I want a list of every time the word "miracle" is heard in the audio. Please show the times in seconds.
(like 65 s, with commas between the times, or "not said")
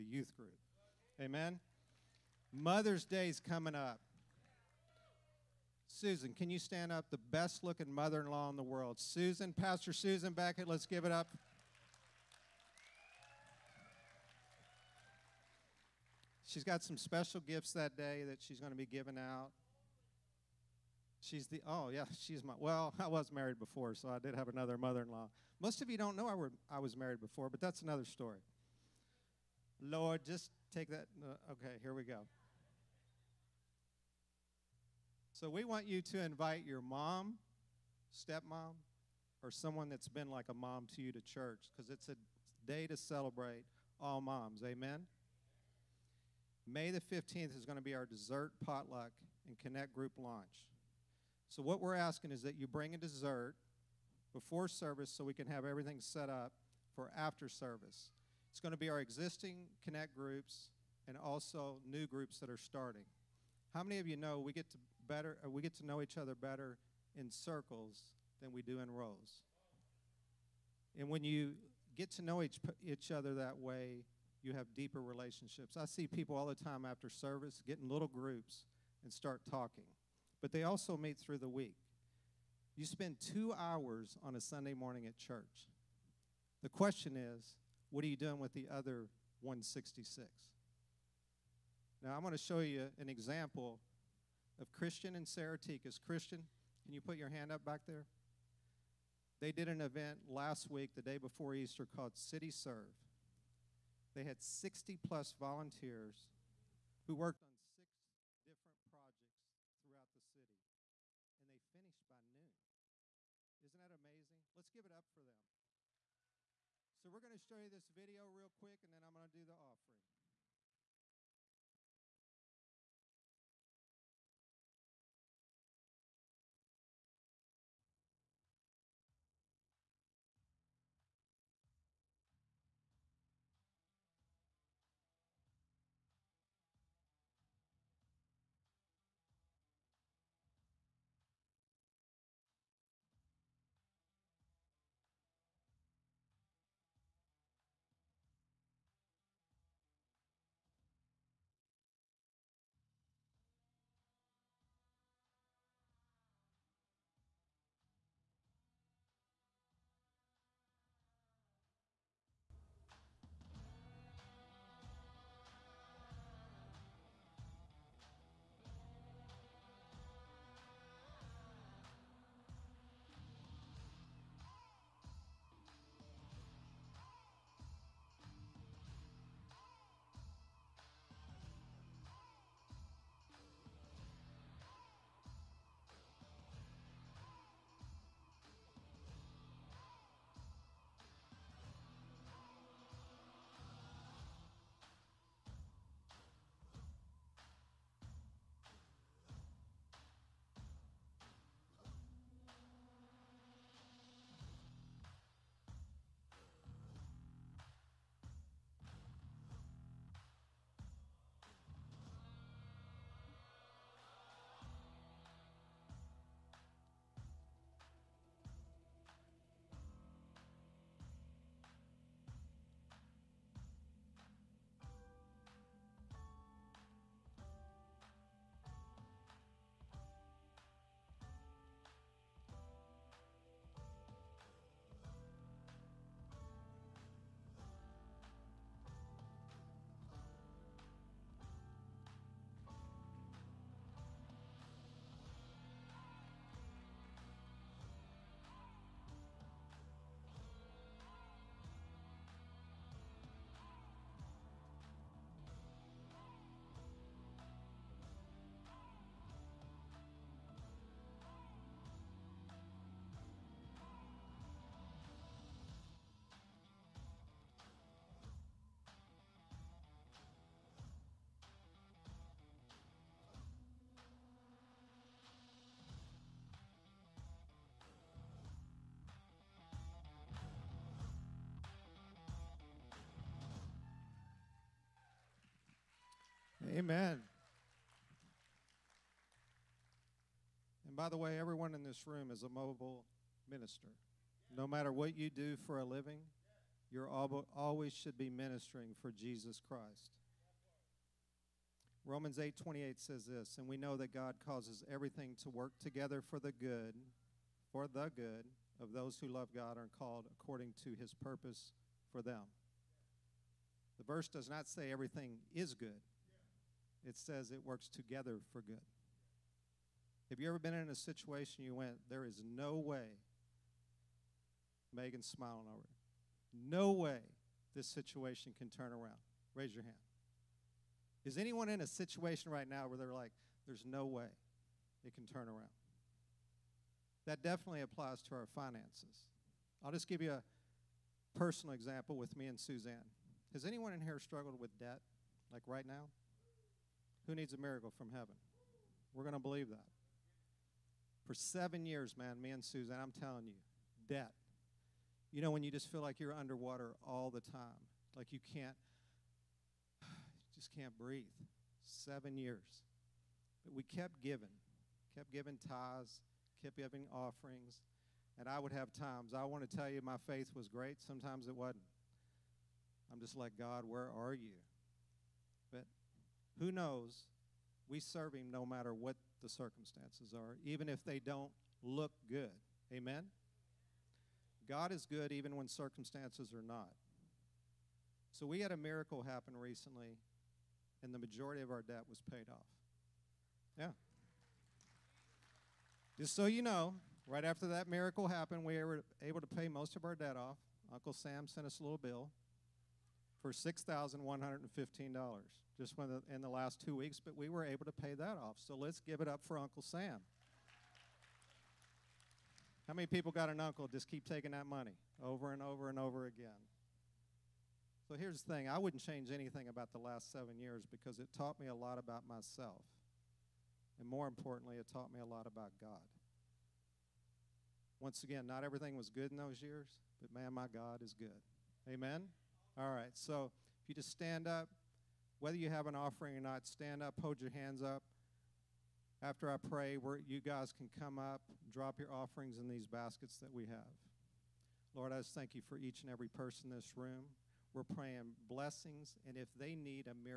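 347 s, 388 s, 397 s.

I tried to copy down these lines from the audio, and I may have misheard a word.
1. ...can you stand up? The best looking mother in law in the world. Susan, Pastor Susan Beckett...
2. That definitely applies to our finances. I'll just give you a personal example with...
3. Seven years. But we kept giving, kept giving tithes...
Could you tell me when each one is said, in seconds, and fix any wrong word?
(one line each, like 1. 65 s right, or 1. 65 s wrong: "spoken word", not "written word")
1. 6 s right
2. 337 s right
3. 361 s right.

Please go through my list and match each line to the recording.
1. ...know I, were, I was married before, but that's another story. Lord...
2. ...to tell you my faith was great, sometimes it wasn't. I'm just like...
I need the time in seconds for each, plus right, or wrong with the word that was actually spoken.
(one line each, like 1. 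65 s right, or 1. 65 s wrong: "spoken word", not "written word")
1. 26 s right
2. 369 s right.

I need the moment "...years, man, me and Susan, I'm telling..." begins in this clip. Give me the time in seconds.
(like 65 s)
351 s.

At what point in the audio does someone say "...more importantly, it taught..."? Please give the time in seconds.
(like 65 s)
424 s.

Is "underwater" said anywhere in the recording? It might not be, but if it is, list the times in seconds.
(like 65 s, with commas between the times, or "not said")
356 s.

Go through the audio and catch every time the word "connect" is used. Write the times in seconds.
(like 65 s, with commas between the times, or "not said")
49 s, 59 s.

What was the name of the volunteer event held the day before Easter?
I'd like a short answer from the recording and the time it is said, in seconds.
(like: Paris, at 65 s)
City Serve, at 102 s.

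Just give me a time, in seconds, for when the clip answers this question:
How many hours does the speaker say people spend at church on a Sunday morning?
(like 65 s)
83 s.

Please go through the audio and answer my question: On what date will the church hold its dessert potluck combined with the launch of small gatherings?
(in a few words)
May 15.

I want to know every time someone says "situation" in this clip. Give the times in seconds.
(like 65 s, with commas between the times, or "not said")
320 s, 327 s, 331 s.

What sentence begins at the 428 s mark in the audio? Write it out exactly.
Once again, not everything was good in those years, but man, my God is good.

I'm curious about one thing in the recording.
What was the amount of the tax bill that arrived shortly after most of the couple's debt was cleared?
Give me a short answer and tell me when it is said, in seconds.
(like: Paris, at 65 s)
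$6,115, at 403 s.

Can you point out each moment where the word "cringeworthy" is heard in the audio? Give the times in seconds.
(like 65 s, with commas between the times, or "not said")
not said.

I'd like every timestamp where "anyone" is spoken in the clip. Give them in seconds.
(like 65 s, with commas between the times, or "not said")
331 s, 343 s.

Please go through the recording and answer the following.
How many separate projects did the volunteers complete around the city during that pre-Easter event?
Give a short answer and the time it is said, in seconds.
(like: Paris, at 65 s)
6, at 107 s.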